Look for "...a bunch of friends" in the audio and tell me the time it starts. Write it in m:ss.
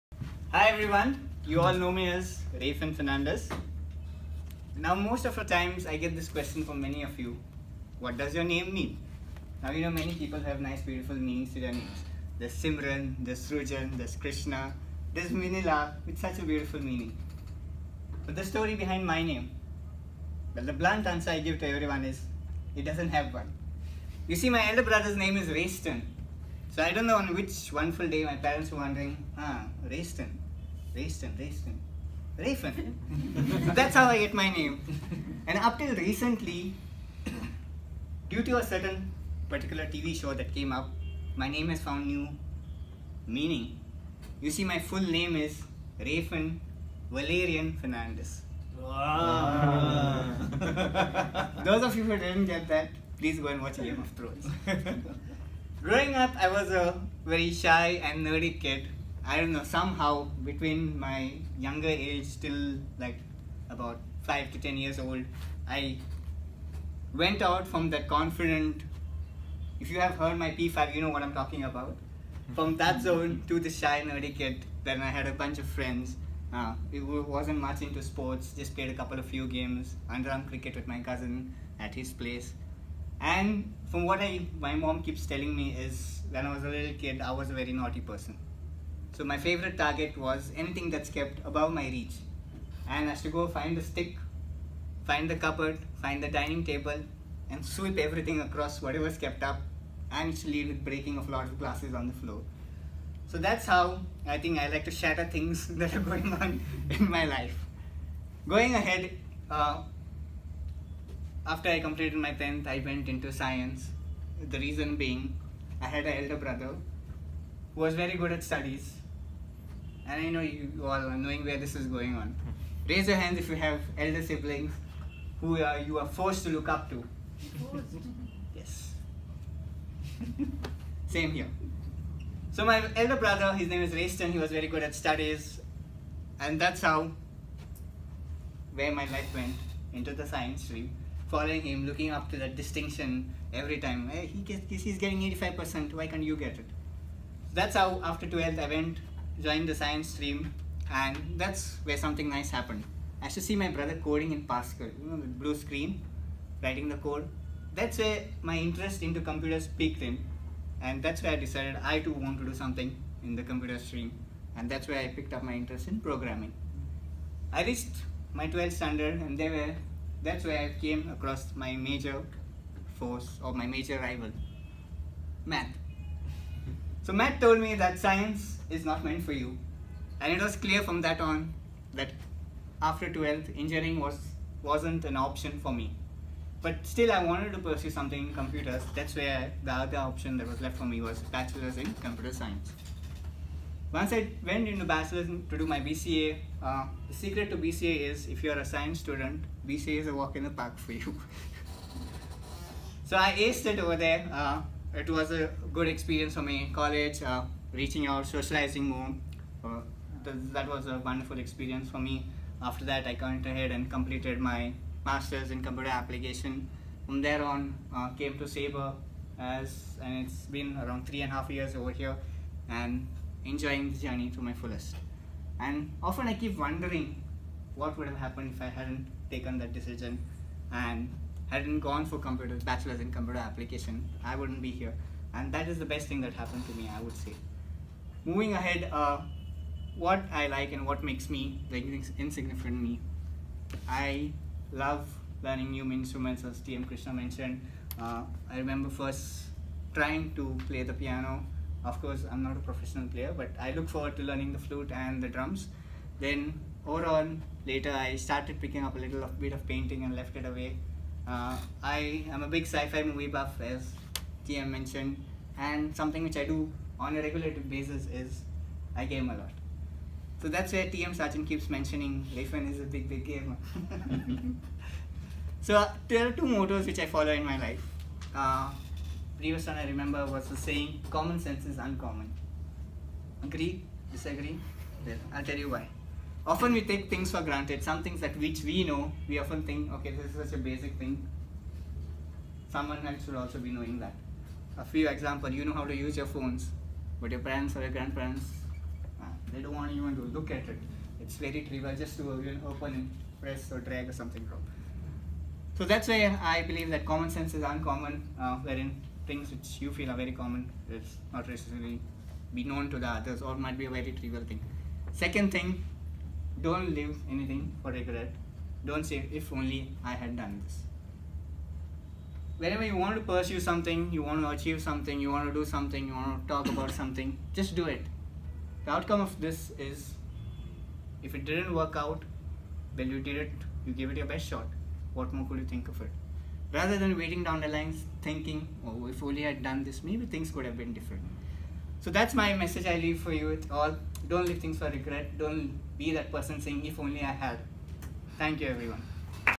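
1:15.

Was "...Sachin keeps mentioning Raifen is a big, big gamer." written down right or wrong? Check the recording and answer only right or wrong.
wrong.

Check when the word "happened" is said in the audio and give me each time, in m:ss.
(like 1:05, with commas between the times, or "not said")
2:32, 3:48, 3:56.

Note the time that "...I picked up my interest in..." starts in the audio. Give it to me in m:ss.
2:44.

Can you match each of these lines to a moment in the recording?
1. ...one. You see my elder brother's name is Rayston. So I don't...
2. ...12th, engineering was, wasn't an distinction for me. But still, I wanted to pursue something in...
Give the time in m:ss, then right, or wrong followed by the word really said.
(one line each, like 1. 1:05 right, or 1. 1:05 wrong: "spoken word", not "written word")
1. 0:23 right
2. 3:03 wrong: "option", not "distinction".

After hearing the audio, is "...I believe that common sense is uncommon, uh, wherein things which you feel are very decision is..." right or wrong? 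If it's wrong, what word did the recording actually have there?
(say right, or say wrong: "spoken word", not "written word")
wrong: "common", not "decision".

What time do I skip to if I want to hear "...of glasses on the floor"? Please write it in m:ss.
1:41.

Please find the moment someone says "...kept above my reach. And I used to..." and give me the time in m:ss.
1:31.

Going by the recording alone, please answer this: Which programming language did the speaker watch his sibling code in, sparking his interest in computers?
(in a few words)
Pascal.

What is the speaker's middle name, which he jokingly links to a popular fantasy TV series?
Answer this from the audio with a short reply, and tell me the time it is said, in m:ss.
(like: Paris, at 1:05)
Valerian, at 0:47.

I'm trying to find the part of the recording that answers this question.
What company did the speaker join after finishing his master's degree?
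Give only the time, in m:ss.
3:38.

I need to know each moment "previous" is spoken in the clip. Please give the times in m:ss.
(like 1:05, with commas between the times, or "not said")
4:39.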